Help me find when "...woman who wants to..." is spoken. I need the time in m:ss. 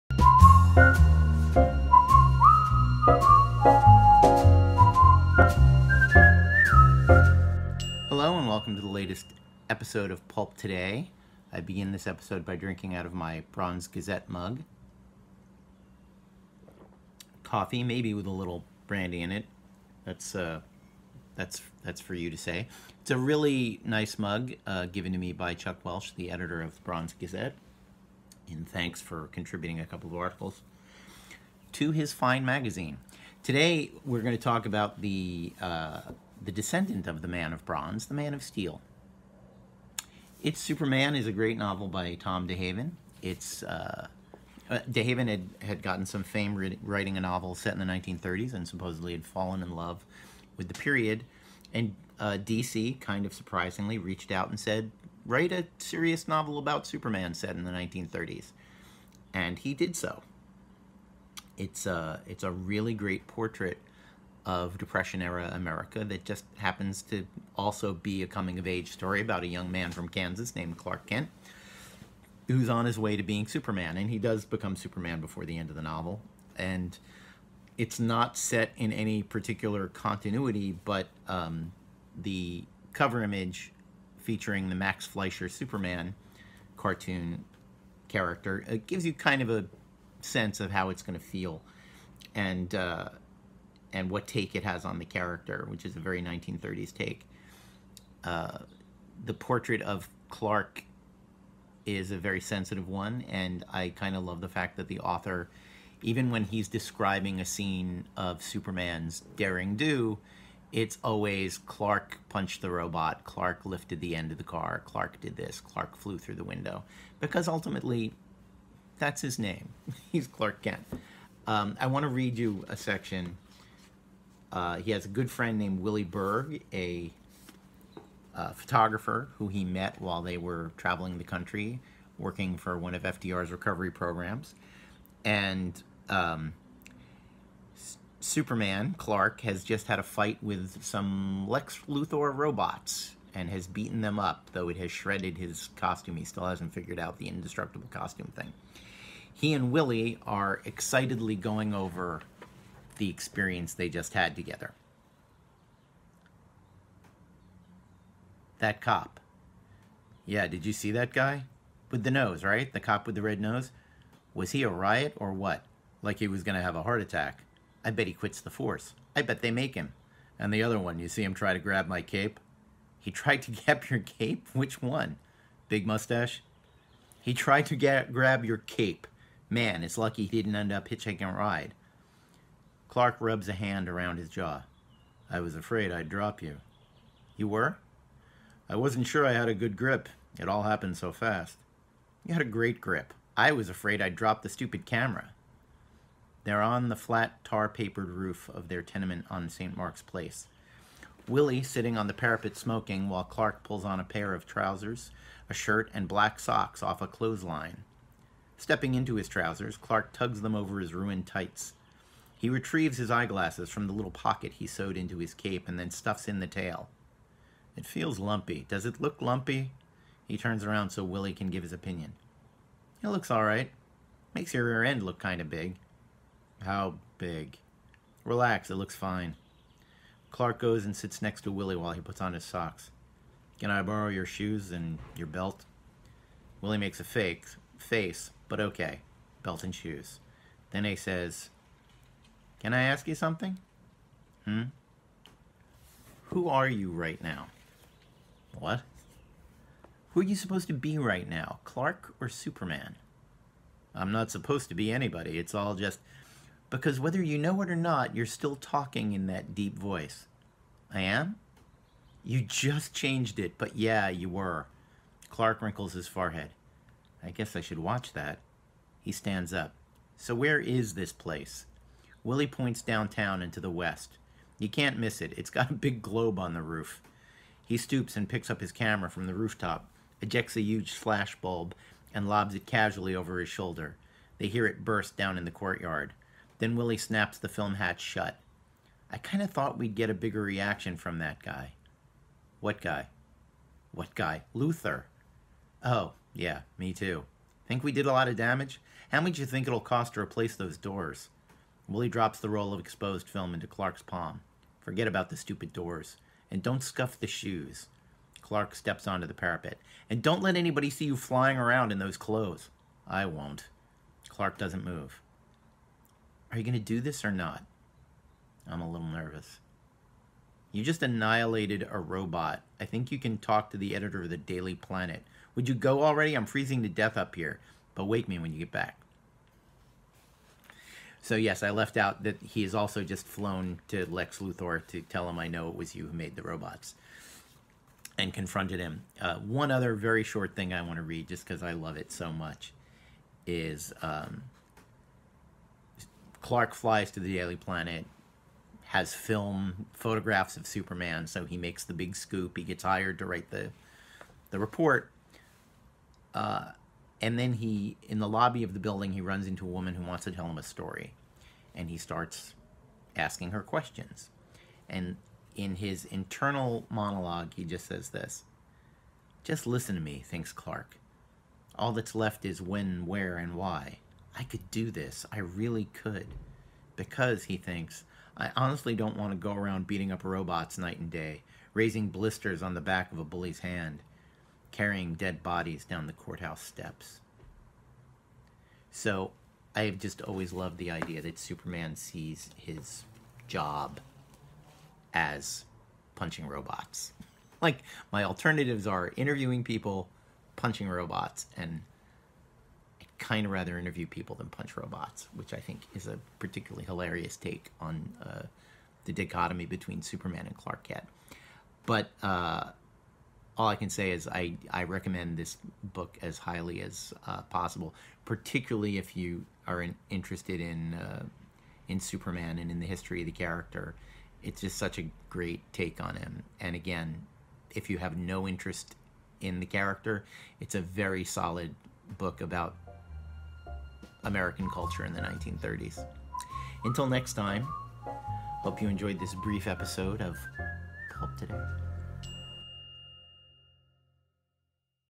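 5:59.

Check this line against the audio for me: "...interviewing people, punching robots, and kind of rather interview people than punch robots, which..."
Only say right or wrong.
right.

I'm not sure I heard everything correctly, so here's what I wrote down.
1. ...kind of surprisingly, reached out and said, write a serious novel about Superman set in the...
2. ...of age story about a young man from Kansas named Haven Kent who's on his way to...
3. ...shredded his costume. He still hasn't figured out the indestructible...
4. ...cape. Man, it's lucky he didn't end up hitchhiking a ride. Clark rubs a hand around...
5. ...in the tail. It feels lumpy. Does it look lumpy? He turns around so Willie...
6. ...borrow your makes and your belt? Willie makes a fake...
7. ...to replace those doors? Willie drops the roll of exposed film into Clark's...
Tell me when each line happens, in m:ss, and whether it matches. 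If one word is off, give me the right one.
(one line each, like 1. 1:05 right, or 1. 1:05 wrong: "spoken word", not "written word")
1. 0:52 right
2. 1:08 wrong: "Clark", not "Haven"
3. 2:24 right
4. 2:58 right
5. 3:36 right
6. 3:53 wrong: "shoes", not "makes"
7. 5:00 right.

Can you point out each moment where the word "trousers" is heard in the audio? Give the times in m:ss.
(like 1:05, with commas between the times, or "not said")
3:24, 3:29.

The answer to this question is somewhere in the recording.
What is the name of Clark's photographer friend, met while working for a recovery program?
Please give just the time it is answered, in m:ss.
2:05.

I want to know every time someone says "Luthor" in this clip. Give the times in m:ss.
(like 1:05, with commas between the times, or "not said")
2:21, 4:54, 5:34.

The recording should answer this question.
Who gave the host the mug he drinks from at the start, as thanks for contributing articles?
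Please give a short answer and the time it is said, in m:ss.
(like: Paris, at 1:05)
Chuck Welch, at 0:25.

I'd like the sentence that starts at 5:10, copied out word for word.
And don't let anybody see you flying around in those clothes.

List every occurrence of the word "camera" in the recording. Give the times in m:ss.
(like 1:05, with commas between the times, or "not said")
3:14, 4:38.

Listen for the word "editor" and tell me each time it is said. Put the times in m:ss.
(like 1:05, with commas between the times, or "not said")
0:26, 5:23.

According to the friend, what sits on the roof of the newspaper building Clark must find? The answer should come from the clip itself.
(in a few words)
a big globe.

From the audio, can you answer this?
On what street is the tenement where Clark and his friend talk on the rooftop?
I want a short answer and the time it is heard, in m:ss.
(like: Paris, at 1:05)
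St. Mark's Place, at 3:19.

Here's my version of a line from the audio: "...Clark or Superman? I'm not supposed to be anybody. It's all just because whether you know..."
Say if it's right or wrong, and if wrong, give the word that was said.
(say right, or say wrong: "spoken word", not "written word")
right.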